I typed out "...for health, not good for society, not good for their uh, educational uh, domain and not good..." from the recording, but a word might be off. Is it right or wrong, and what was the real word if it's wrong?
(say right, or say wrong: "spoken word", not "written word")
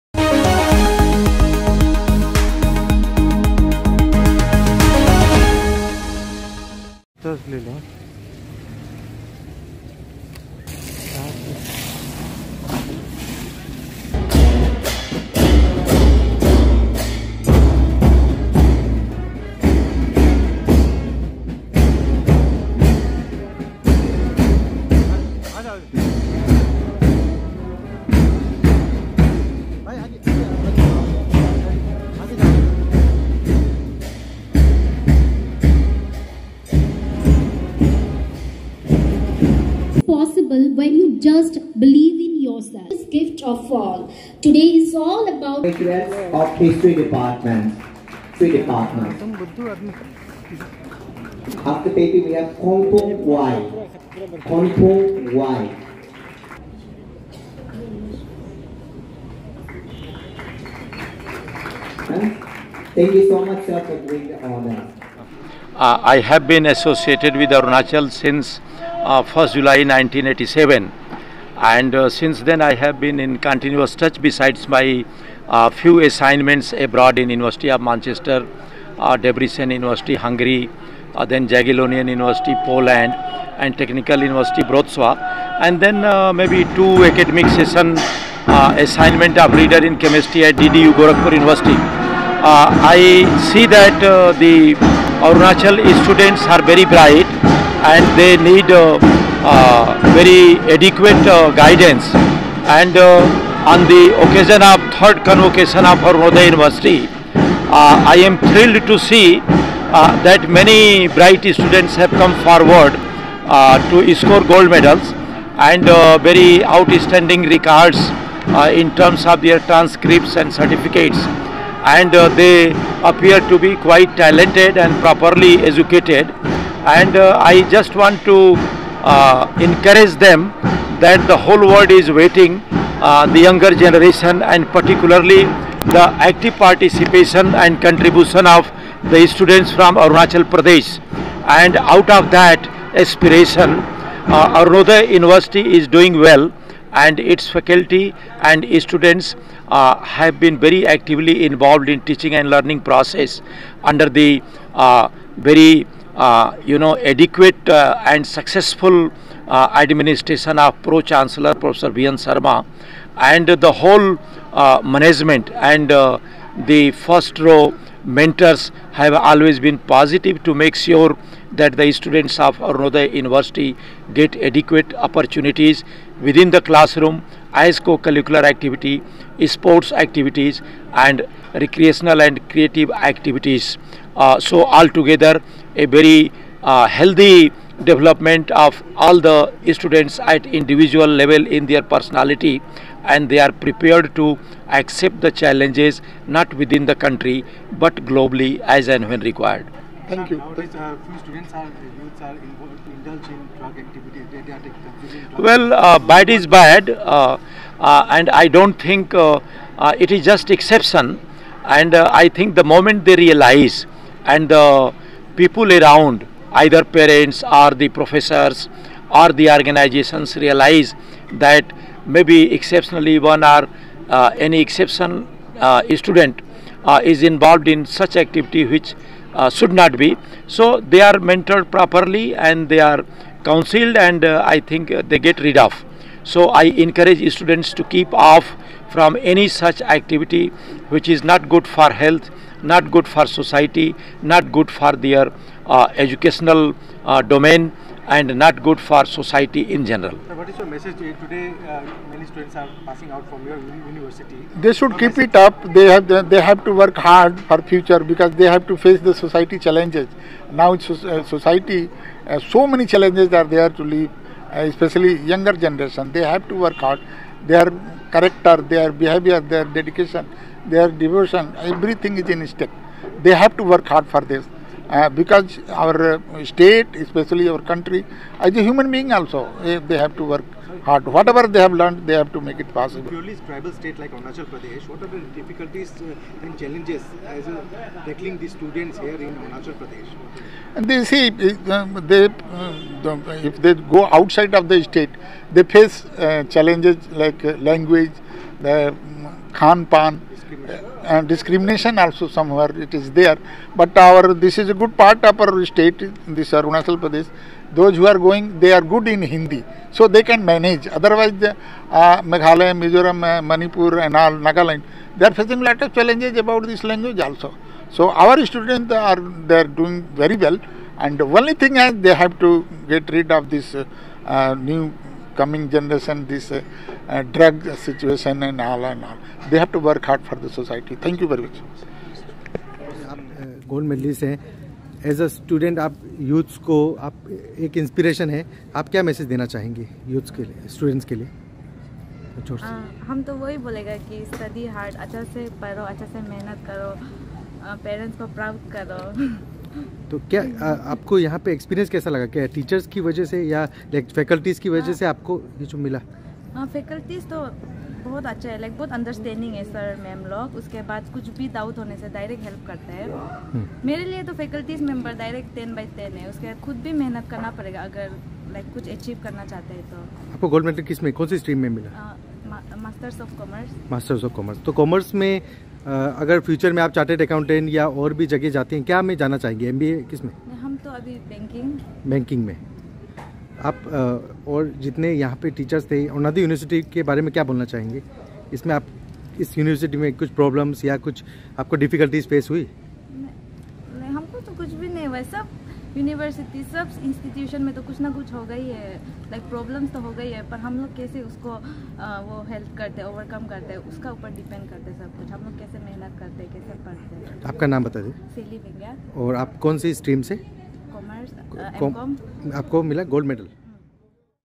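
right.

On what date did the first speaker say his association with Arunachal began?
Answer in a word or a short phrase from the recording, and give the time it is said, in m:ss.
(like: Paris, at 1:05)
1 July 1987, at 1:09.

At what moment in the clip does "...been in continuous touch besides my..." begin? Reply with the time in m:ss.
1:12.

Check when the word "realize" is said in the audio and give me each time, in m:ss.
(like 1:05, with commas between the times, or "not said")
3:33, 3:40.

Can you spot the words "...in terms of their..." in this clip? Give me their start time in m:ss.
1:58.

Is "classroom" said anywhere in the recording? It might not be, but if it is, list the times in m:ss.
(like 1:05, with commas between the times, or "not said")
2:56.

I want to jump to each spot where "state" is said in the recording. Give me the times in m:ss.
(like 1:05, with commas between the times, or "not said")
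4:36, 4:43, 4:54, 5:05.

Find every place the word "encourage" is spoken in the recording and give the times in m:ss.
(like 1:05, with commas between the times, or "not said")
2:09, 3:56.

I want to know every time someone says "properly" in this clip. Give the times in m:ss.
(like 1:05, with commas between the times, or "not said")
2:05, 3:51.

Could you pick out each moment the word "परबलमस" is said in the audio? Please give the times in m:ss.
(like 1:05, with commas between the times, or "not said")
6:30, 6:39.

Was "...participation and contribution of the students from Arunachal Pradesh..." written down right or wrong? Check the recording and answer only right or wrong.
right.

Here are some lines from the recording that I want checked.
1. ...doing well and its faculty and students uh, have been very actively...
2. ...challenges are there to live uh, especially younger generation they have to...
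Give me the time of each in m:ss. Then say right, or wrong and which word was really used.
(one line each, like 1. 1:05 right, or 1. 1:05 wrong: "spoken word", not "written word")
1. 2:25 right
2. 4:22 right.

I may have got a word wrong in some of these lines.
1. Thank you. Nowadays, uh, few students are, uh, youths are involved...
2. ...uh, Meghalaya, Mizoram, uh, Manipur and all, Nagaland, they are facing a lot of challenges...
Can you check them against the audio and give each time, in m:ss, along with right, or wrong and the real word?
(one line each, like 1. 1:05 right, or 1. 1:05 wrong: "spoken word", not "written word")
1. 3:20 right
2. 5:11 right.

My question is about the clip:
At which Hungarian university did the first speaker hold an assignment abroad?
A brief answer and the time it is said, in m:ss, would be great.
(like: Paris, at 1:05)
Debrecen University, at 1:19.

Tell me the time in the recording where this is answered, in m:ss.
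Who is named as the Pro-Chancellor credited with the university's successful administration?
2:41.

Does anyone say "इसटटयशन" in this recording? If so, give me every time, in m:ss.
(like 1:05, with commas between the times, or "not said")
6:37.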